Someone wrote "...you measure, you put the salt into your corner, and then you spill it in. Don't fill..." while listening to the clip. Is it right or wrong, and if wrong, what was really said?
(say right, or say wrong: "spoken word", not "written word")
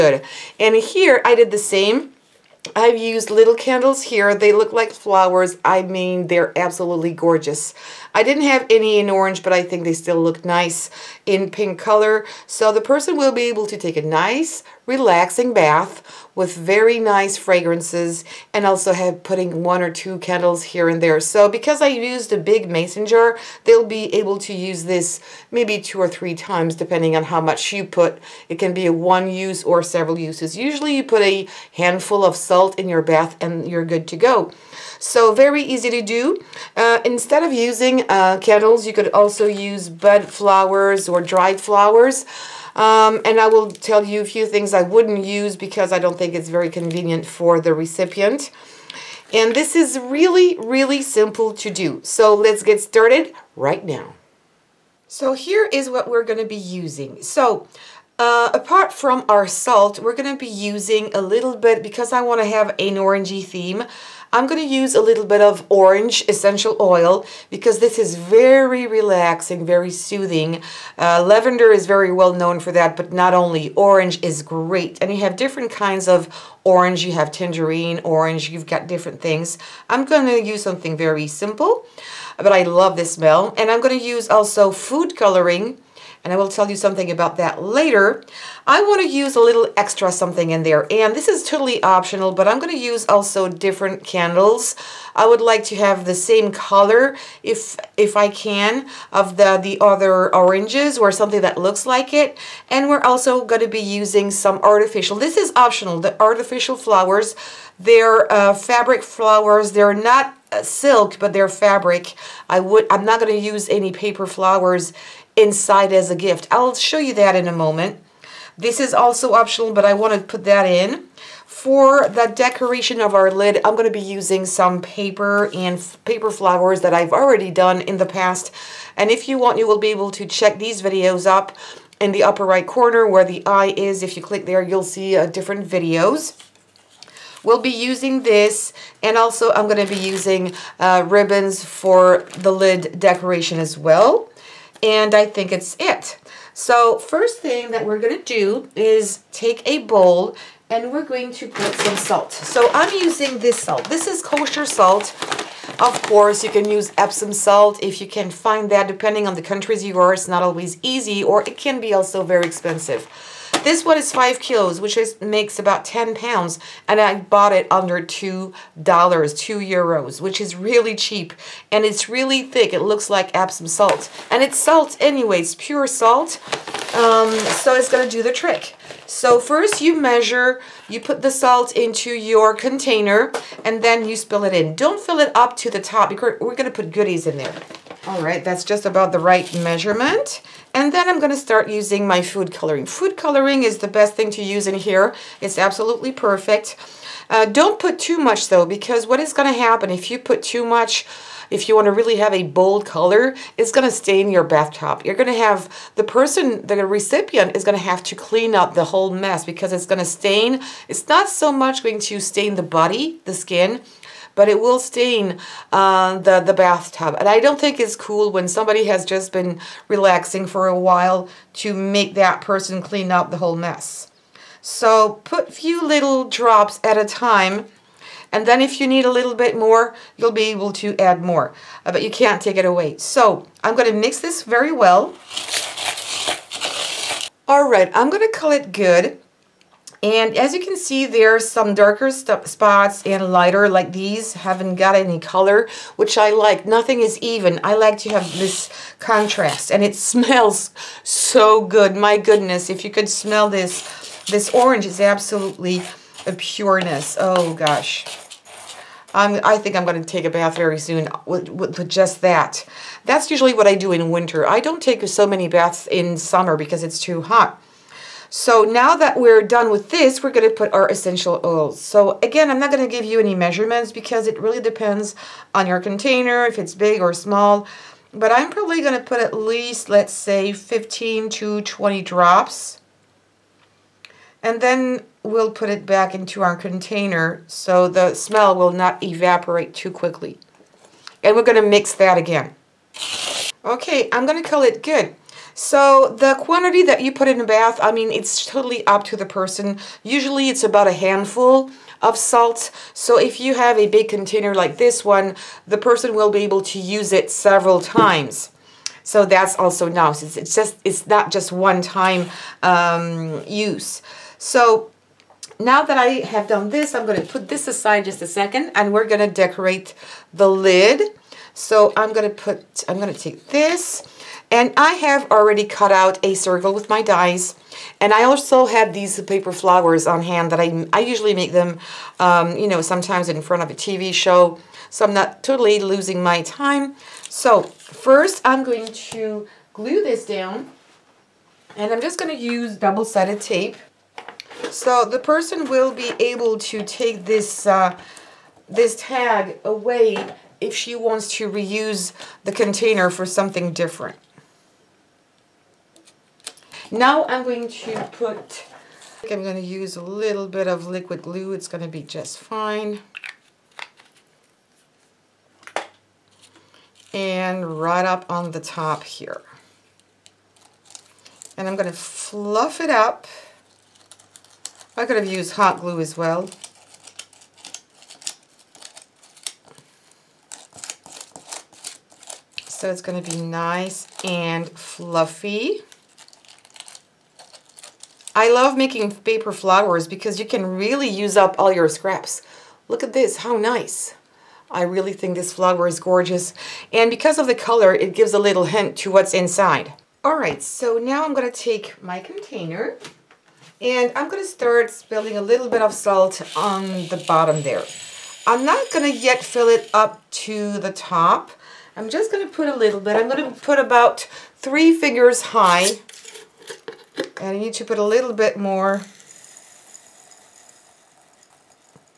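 wrong: "container", not "corner".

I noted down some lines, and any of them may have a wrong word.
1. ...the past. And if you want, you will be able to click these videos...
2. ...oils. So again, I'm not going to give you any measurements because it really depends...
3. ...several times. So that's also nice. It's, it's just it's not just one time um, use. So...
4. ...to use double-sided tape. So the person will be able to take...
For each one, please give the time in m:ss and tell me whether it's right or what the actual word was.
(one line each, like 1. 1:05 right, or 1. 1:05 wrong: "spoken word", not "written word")
1. 2:07 wrong: "check", not "click"
2. 4:31 right
3. 5:07 right
4. 5:42 right.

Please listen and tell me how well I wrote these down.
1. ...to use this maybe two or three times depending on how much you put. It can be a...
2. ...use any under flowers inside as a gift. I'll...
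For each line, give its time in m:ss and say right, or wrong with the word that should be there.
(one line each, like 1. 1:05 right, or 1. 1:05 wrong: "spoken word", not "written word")
1. 0:24 right
2. 1:53 wrong: "paper", not "under".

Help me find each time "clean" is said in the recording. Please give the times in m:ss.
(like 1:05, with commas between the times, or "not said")
3:28, 3:42.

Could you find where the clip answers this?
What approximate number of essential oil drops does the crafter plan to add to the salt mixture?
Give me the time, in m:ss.
4:40.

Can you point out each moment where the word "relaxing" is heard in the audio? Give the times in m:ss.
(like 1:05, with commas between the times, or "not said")
0:14, 1:08, 3:39.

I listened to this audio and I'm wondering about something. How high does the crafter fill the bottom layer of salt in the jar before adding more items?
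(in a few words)
three fingers high.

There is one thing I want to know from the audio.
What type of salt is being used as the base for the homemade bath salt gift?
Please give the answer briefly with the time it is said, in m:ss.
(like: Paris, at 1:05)
kosher salt, at 2:34.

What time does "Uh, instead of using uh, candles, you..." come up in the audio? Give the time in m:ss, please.
0:36.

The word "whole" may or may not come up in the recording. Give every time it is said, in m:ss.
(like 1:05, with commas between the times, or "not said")
3:28, 3:43.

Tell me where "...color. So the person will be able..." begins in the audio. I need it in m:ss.
0:11.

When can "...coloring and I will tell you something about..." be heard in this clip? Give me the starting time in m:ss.
1:25.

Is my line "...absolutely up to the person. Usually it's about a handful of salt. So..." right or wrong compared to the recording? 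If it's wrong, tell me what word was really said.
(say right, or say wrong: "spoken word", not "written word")
wrong: "totally", not "absolutely".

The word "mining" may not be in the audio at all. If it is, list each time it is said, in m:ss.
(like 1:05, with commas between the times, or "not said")
not said.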